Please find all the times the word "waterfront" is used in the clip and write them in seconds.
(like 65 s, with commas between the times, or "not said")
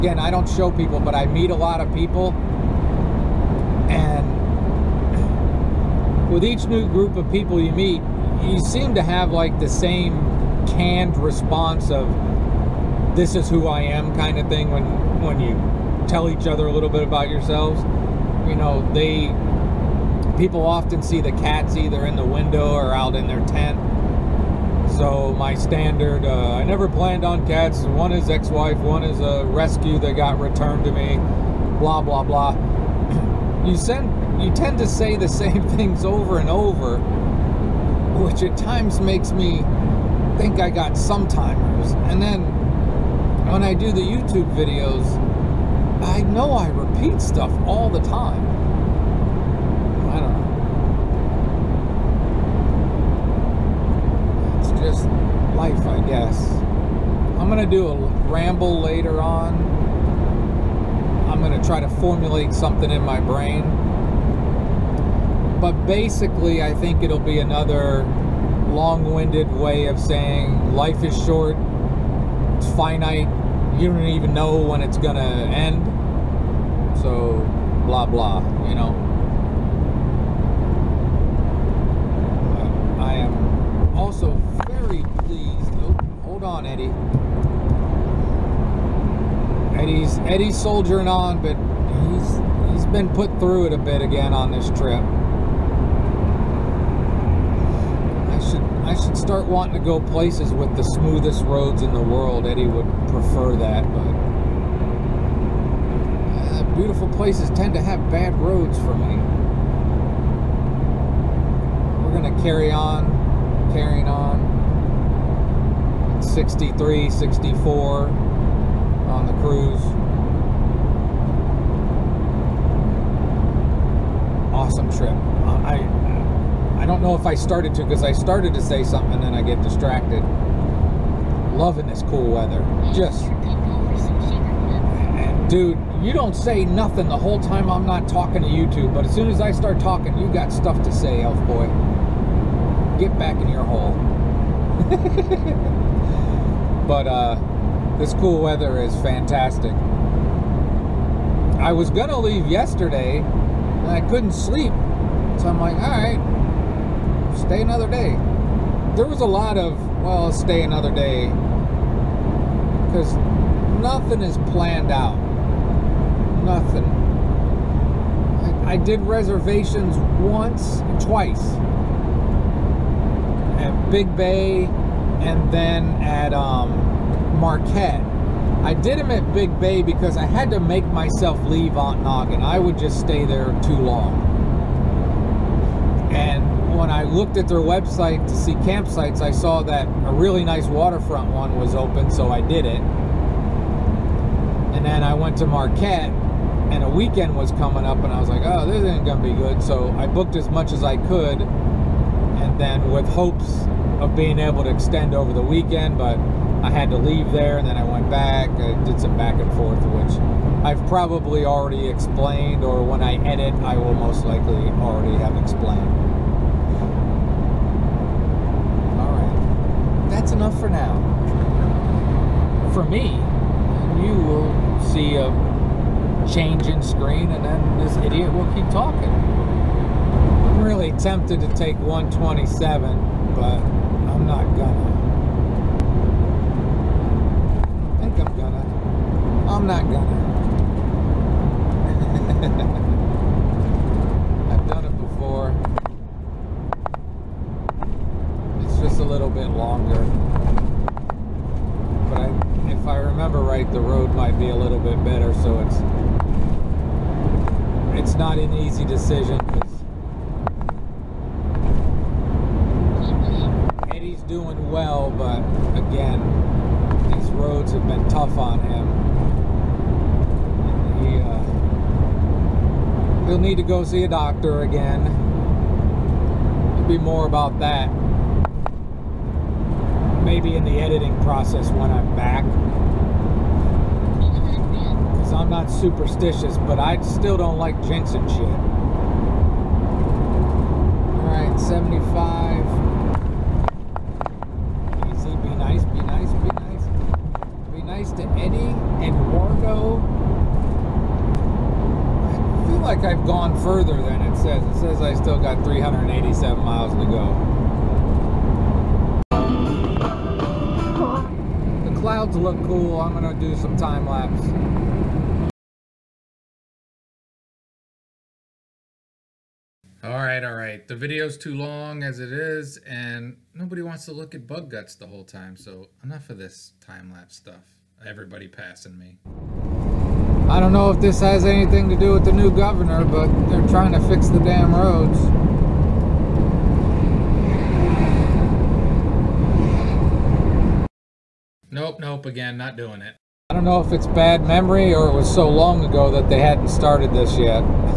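190 s.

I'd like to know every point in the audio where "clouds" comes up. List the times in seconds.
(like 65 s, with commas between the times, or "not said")
311 s.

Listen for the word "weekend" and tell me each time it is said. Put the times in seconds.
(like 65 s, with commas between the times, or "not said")
196 s, 205 s.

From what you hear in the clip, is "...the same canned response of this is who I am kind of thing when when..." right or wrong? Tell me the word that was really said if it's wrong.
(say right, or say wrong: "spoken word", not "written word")
right.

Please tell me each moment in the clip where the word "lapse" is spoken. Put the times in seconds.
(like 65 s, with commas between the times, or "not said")
314 s, 327 s.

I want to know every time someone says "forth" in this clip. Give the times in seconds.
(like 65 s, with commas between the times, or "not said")
209 s.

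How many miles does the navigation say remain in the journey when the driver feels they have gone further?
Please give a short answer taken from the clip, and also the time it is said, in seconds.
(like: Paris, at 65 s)
387, at 305 s.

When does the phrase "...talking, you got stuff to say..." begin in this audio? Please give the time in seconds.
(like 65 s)
139 s.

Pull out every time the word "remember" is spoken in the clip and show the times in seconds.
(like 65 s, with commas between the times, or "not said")
252 s.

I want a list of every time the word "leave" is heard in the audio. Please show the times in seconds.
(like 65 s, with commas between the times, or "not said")
152 s, 181 s, 206 s.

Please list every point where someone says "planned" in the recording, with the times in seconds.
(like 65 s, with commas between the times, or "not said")
26 s, 164 s.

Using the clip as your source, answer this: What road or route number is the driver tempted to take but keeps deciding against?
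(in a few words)
127.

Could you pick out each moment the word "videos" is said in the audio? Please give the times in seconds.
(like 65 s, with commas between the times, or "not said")
44 s, 320 s.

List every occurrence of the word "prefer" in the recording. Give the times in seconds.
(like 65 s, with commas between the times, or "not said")
103 s.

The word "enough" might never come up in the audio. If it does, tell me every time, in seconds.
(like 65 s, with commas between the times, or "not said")
220 s, 326 s.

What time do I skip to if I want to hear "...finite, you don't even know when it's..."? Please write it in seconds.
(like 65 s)
72 s.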